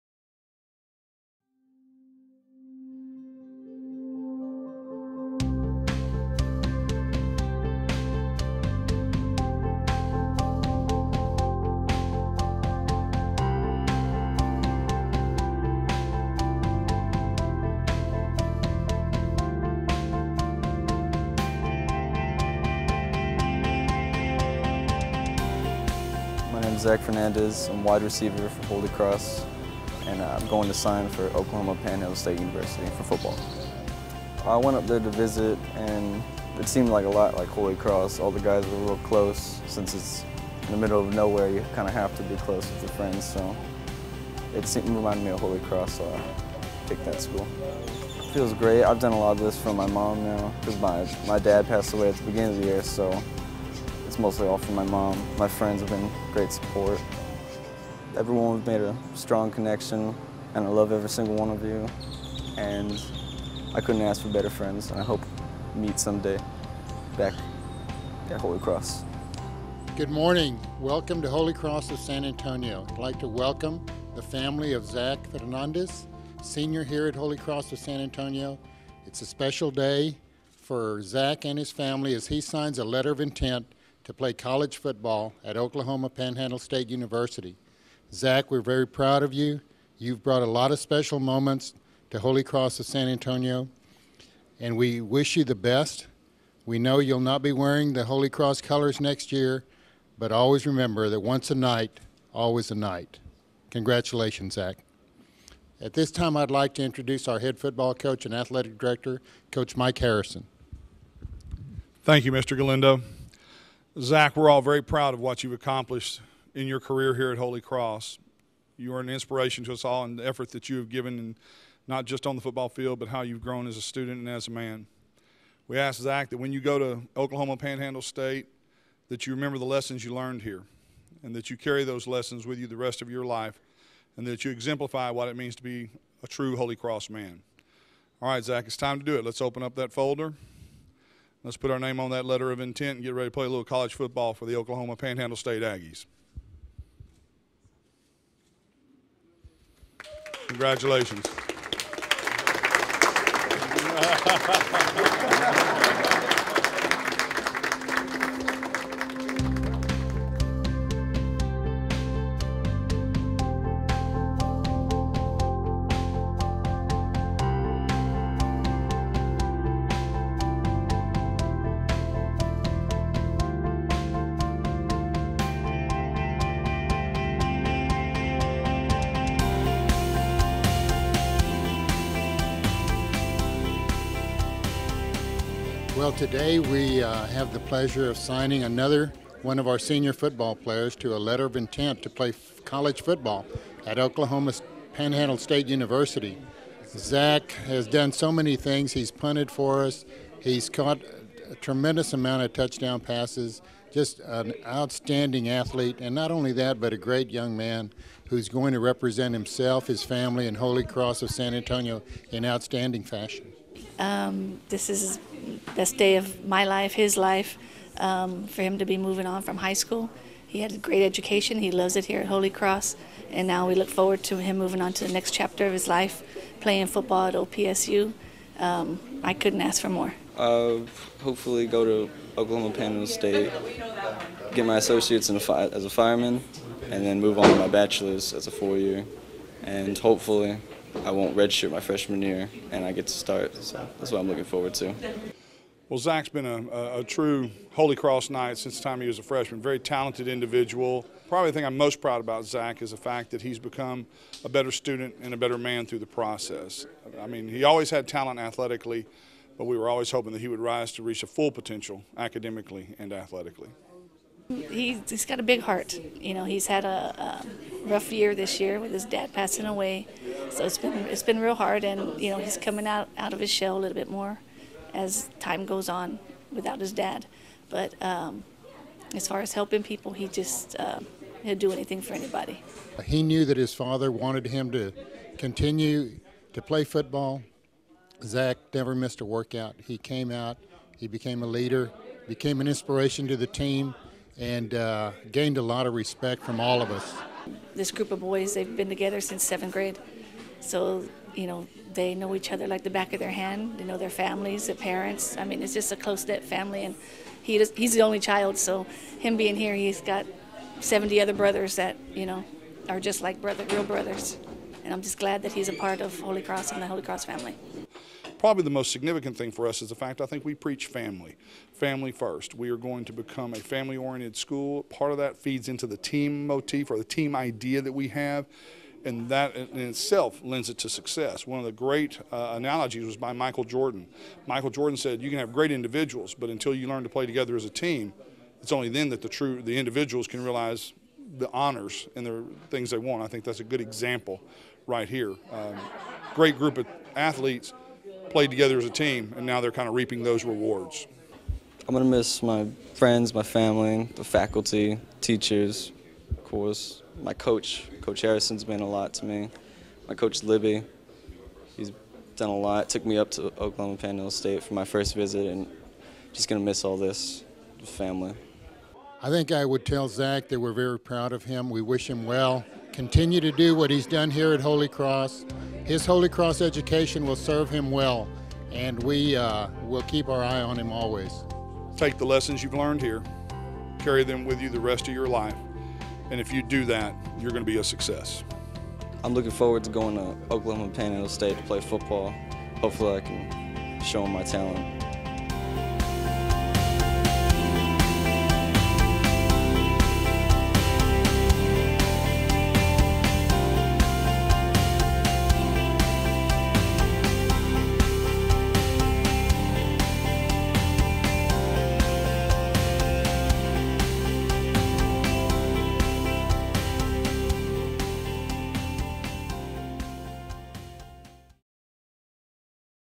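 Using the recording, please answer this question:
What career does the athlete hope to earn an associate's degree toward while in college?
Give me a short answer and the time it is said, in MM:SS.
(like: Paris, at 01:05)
Fireman, at 03:55.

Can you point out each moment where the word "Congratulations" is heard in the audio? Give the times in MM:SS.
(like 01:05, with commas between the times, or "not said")
01:43, 02:30.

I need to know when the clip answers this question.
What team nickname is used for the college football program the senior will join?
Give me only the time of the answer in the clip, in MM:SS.
02:25.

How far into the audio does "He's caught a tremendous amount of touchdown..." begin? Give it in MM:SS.
03:20.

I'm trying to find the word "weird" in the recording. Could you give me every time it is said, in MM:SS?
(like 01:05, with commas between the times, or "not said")
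not said.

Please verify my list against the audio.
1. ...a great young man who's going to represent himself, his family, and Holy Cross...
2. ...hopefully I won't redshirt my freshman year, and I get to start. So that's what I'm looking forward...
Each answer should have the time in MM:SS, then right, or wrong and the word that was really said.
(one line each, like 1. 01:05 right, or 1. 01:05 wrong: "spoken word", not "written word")
1. 03:26 right
2. 03:59 right.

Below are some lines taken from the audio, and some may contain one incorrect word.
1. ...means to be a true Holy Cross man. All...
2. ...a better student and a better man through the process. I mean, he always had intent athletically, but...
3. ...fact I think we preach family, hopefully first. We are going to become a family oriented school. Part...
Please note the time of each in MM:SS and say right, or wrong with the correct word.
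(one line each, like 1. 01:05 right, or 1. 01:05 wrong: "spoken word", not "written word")
1. 02:15 right
2. 04:14 wrong: "talent", not "intent"
3. 05:19 wrong: "family", not "hopefully".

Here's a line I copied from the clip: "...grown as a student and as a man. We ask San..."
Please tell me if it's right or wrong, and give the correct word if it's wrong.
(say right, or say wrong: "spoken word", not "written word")
wrong: "Zach", not "San".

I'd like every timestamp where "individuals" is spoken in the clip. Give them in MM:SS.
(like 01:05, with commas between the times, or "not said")
04:10, 05:35, 05:39.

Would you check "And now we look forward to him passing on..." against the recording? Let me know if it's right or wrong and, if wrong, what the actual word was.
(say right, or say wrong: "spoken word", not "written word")
wrong: "moving", not "passing".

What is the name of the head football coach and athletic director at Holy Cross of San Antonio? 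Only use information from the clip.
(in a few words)
Mike Harrison.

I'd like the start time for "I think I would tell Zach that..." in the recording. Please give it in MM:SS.
06:09.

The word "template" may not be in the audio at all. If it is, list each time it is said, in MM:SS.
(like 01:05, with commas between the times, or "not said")
not said.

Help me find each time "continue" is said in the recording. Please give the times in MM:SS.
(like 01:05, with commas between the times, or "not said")
04:45, 06:12.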